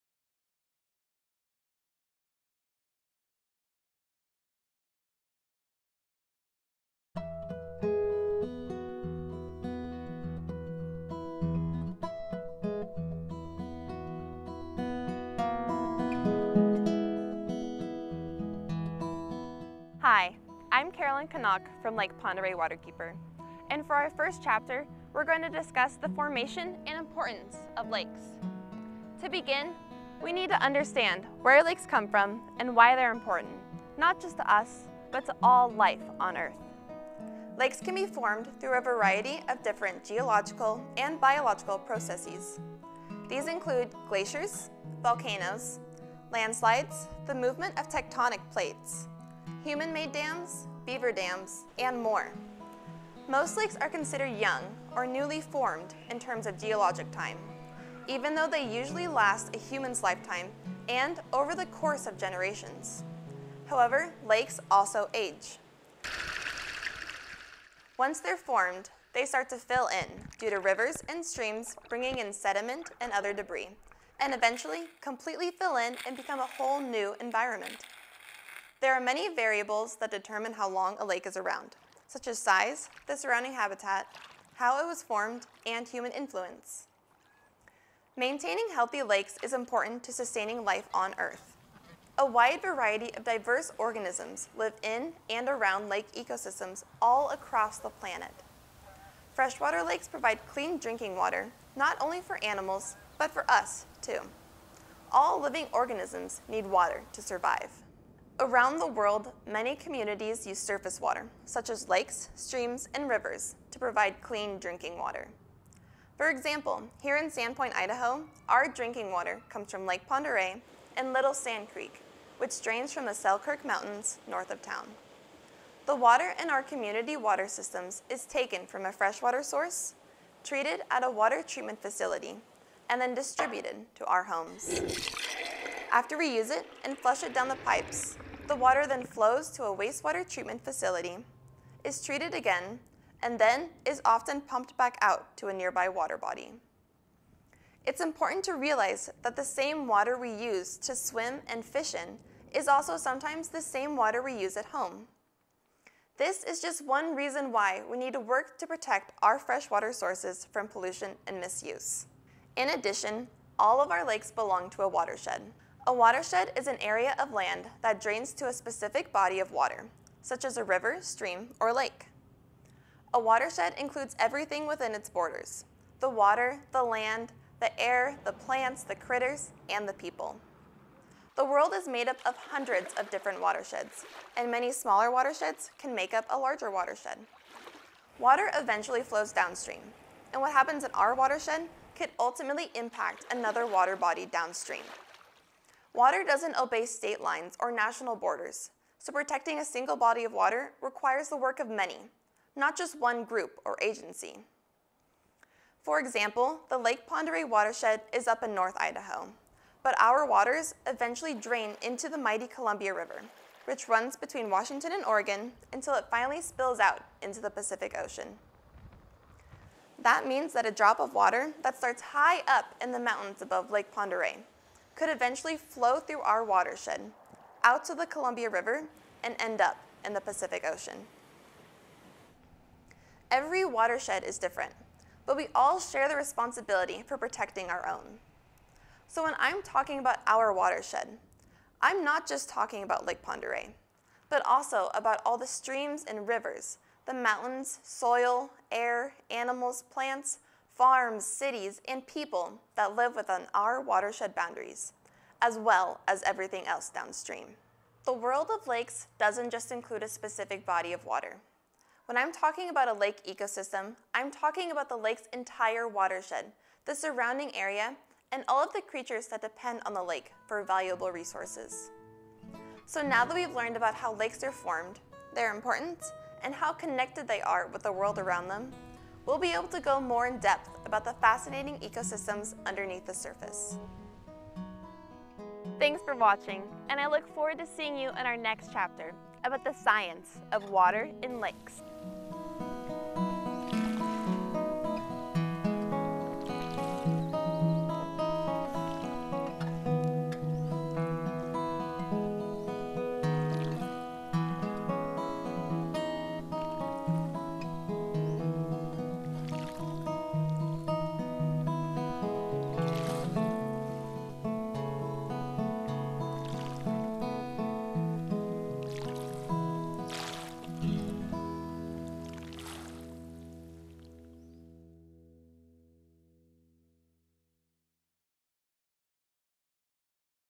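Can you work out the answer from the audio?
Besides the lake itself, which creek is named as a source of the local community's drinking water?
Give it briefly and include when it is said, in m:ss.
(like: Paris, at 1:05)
Little Sand Creek, at 2:01.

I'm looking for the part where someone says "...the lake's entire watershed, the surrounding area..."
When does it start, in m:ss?
4:24.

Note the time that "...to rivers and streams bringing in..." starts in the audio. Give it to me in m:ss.
1:10.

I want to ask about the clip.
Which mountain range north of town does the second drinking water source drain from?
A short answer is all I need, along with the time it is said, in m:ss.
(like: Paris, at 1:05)
Selkirk Mountains, at 2:03.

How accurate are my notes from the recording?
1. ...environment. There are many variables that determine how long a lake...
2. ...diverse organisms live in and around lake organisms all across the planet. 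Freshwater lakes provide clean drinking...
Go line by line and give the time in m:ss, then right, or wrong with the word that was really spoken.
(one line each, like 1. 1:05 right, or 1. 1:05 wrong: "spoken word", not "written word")
1. 1:17 right
2. 1:33 wrong: "ecosystems", not "organisms".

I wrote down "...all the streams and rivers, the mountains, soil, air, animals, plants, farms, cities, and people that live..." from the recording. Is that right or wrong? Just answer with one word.
right.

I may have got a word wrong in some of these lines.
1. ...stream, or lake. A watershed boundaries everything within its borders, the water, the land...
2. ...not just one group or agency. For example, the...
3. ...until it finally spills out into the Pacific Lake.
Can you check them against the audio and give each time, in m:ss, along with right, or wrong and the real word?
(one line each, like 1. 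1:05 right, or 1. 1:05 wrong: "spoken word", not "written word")
1. 2:51 wrong: "includes", not "boundaries"
2. 3:22 right
3. 3:35 wrong: "Ocean", not "Lake".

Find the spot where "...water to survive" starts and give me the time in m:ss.
1:46.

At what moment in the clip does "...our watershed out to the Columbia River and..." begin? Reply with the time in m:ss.
3:46.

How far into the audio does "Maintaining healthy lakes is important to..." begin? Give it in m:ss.
1:28.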